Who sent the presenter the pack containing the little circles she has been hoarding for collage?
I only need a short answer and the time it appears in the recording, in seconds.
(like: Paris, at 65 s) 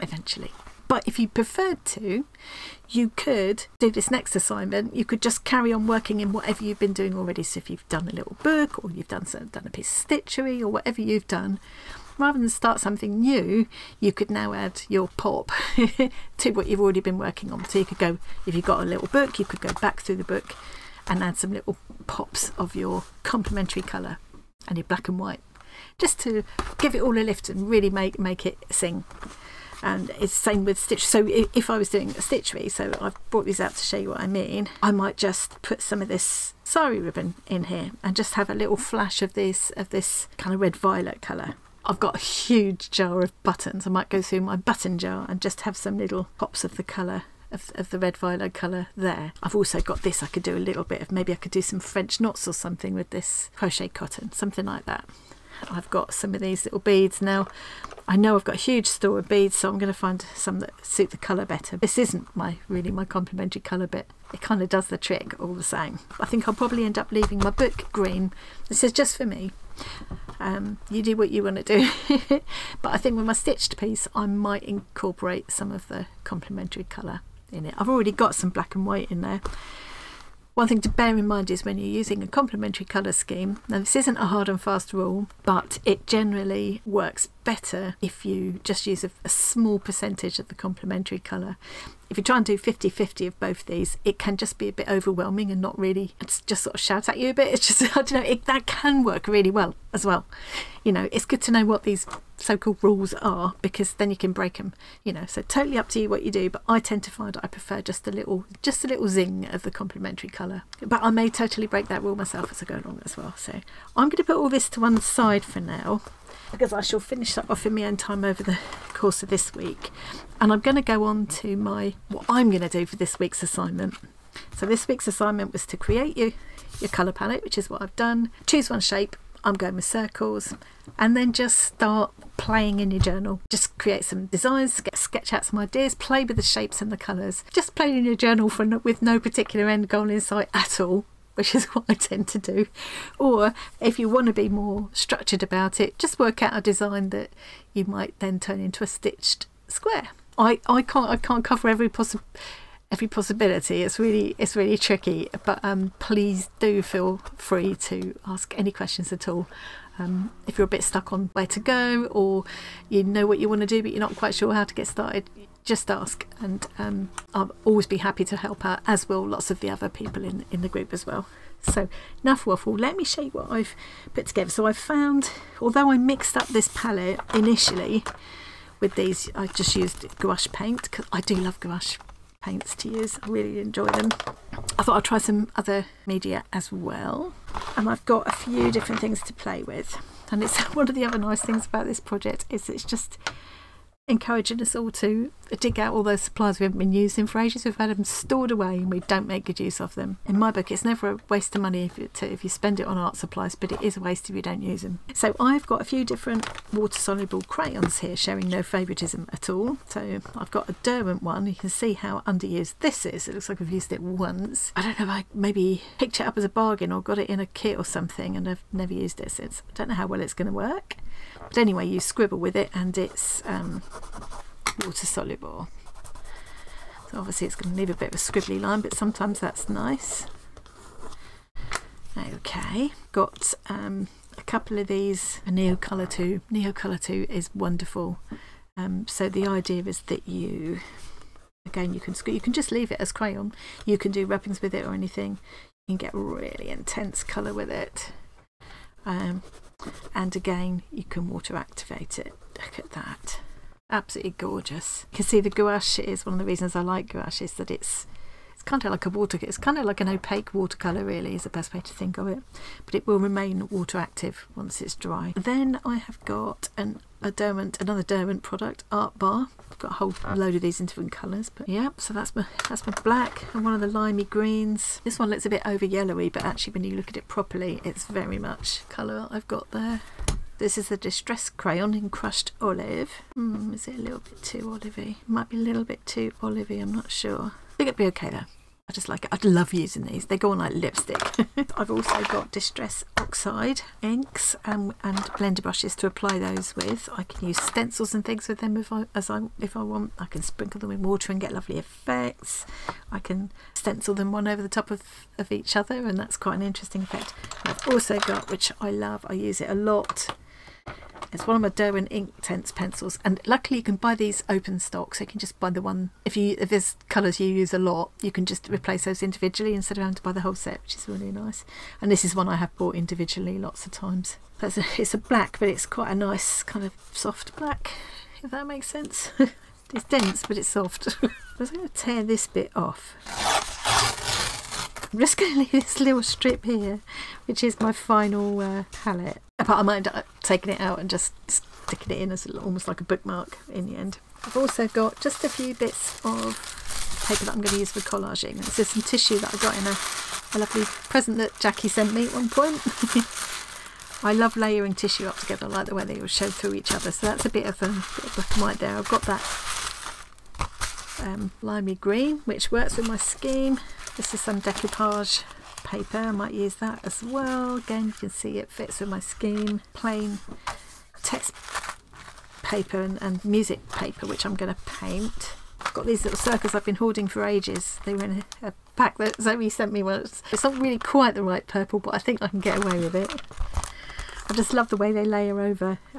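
Zoe, at 379 s.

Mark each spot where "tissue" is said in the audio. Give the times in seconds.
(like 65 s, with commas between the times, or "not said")
349 s, 354 s.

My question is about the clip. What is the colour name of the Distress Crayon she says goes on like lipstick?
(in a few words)
Crushed Olive.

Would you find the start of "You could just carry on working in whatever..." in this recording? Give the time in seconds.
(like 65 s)
4 s.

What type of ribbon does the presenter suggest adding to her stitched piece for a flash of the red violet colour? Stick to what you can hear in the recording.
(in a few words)
Sari ribbon.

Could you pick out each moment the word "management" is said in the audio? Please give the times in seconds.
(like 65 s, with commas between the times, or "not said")
not said.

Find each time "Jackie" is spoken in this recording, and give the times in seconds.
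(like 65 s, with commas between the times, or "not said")
351 s.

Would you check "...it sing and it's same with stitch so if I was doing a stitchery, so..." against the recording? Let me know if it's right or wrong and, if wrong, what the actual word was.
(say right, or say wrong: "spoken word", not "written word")
right.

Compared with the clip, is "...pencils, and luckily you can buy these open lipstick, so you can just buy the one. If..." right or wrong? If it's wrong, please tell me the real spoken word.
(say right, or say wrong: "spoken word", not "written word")
wrong: "stock", not "lipstick".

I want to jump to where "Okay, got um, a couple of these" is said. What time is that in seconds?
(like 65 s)
232 s.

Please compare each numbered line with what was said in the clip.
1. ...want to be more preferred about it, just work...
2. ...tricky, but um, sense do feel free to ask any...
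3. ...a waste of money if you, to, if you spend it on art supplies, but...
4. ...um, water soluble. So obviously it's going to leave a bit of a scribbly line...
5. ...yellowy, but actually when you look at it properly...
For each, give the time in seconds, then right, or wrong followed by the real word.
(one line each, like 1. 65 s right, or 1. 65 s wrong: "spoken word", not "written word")
1. 144 s wrong: "structured", not "preferred"
2. 154 s wrong: "please", not "sense"
3. 201 s right
4. 223 s right
5. 275 s right.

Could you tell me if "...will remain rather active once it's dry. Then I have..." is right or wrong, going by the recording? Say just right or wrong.
wrong.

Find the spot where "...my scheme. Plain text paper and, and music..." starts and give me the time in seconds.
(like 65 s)
369 s.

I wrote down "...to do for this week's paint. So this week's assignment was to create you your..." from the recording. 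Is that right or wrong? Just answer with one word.
wrong.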